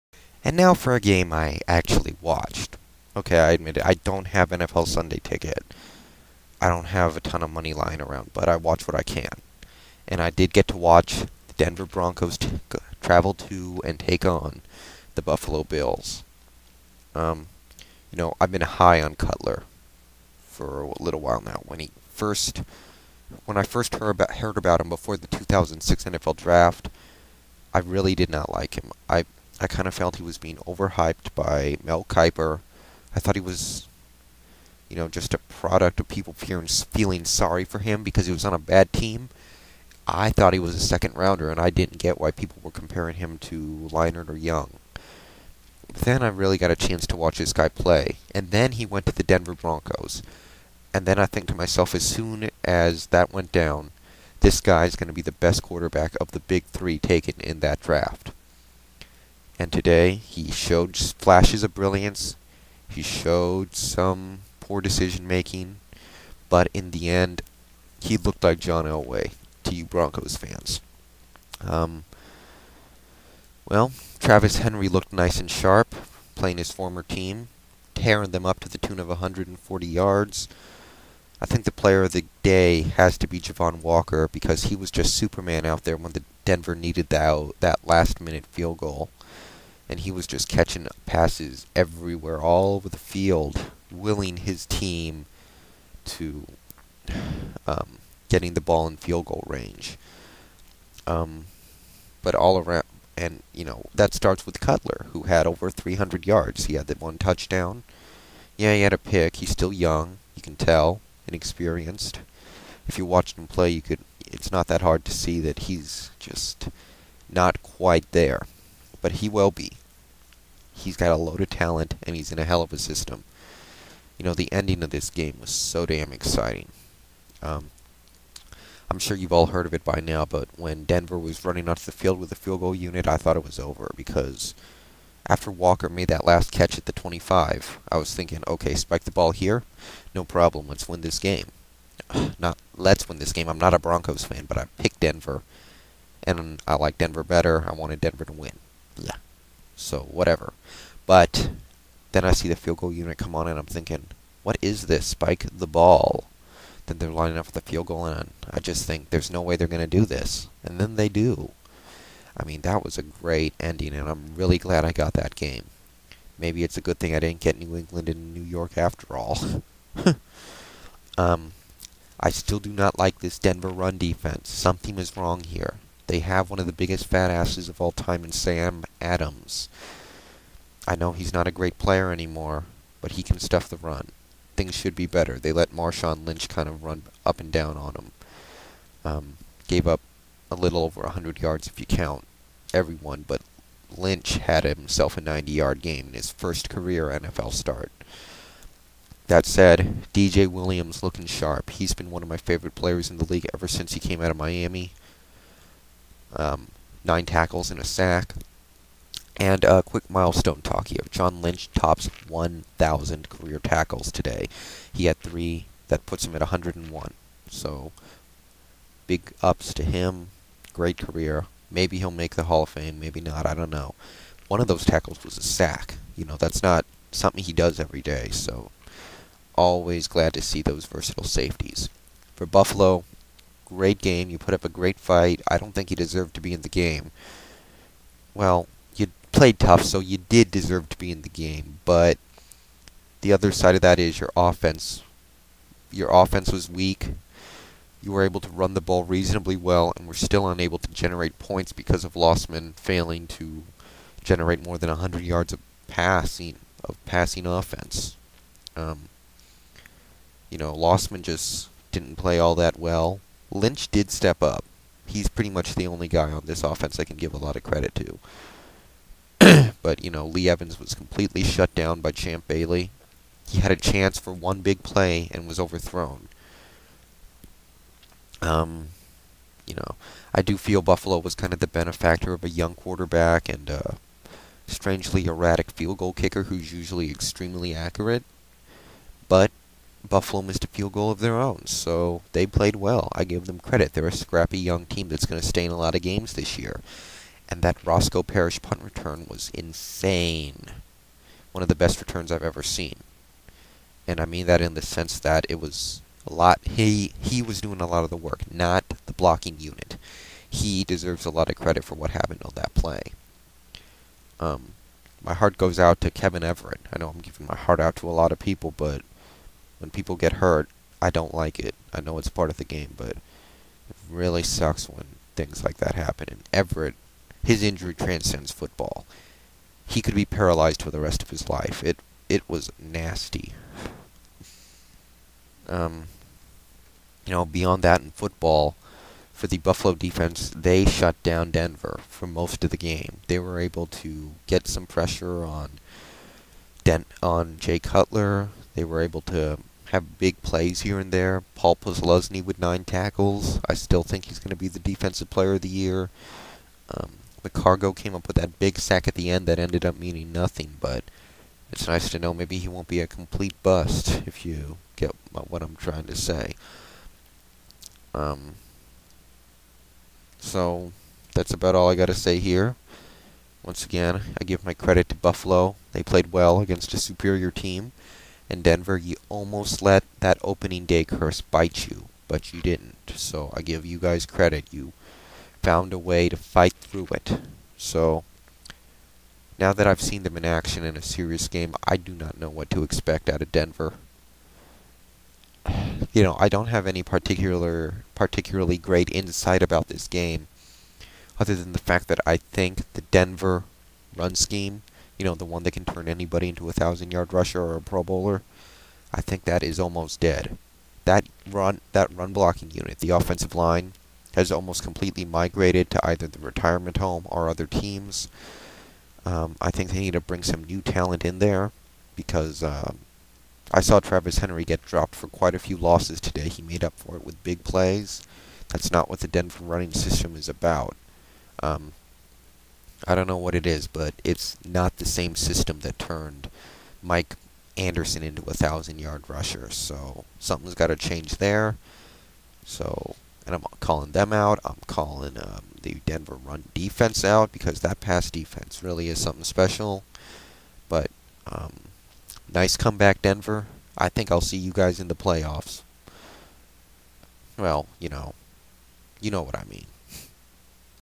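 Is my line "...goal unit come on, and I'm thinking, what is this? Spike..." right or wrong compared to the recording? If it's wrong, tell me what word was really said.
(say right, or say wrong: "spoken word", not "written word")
right.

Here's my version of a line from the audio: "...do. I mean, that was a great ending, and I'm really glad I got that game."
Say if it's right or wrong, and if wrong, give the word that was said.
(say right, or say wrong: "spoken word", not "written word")
right.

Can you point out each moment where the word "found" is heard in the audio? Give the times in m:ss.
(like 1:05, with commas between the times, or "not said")
6:25.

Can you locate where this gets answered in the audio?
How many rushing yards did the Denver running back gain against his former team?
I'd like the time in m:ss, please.
1:19.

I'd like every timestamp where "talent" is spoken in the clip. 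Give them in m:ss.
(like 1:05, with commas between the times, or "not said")
2:01, 7:00.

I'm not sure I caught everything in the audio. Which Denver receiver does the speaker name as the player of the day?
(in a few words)
Javon Walker.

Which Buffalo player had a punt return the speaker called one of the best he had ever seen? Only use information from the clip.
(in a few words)
Roscoe Parrish.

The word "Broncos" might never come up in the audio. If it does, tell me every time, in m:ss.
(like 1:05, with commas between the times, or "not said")
0:11, 0:49, 1:09, 2:23.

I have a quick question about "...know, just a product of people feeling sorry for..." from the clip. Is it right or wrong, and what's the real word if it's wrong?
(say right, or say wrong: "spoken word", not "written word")
right.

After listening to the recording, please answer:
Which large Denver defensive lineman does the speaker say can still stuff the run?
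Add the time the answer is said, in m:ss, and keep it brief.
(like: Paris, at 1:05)
Sam Adams, at 2:58.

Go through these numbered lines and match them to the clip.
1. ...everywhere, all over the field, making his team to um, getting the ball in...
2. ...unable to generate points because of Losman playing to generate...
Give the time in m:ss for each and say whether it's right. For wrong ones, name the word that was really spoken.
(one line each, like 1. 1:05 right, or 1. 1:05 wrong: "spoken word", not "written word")
1. 1:31 wrong: "willing", not "making"
2. 4:10 wrong: "failing", not "playing".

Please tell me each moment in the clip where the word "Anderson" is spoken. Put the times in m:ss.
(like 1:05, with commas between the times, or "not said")
7:17.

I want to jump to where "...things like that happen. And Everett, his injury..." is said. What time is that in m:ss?
5:25.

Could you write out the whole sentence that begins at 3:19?
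That said, DJ Williams looking sharp.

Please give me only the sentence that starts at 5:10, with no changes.
He deserves a lot of credit for what happened on that play.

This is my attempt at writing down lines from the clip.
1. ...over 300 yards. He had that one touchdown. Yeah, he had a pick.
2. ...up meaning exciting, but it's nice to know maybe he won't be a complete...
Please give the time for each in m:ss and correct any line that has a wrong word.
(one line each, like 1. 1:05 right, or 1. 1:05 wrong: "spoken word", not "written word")
1. 1:45 right
2. 5:59 wrong: "nothing", not "exciting".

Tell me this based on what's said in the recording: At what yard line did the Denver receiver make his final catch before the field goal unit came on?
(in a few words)
25.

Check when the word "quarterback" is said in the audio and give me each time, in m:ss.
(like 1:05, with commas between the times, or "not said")
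0:55, 4:42.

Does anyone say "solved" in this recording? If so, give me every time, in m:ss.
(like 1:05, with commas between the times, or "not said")
not said.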